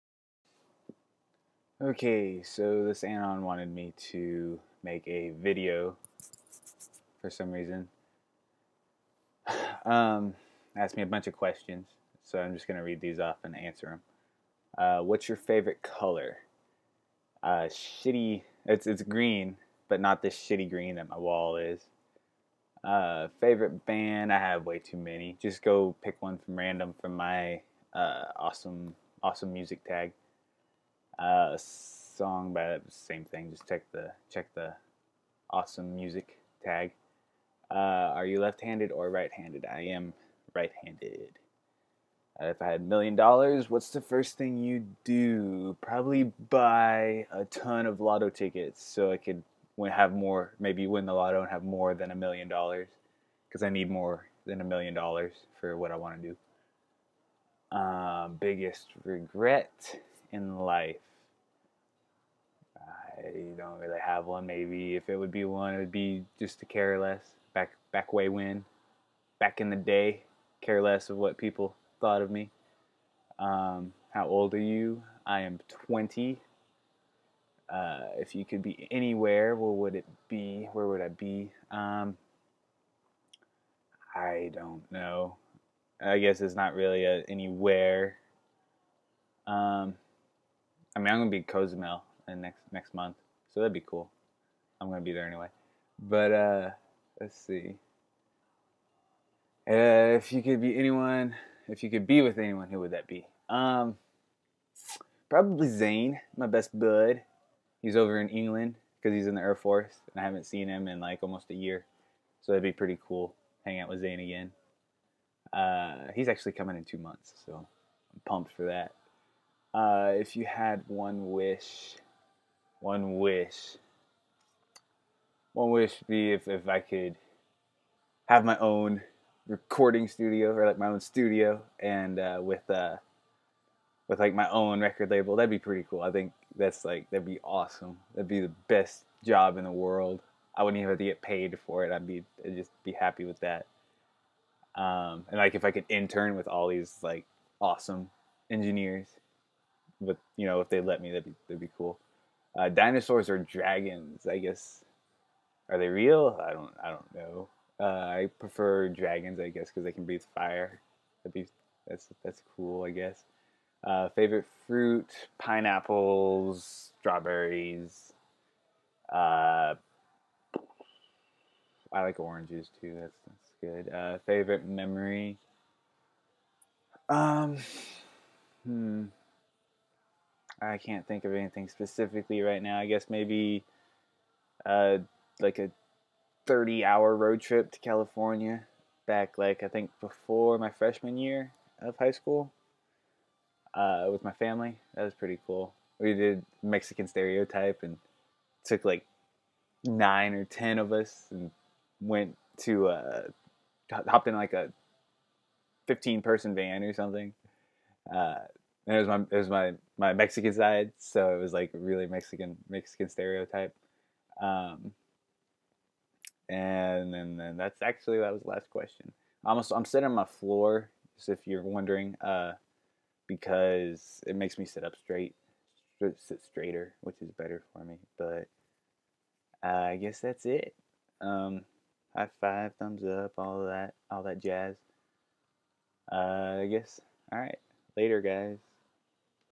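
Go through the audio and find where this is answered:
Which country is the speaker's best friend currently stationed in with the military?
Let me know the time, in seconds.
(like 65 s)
108 s.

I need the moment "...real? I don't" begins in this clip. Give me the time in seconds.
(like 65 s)
155 s.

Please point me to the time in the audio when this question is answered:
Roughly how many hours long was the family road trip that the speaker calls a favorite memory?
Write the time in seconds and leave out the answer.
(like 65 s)
186 s.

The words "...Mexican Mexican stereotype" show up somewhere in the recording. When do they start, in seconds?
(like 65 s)
212 s.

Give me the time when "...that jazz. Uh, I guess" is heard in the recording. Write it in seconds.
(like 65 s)
234 s.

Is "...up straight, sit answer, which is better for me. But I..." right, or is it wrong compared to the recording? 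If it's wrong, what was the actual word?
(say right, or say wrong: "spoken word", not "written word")
wrong: "straighter", not "answer".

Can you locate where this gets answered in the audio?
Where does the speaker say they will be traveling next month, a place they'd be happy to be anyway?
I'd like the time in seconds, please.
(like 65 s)
91 s.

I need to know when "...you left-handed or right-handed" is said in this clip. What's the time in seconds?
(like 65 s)
38 s.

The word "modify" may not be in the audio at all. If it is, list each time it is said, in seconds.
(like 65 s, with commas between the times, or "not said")
not said.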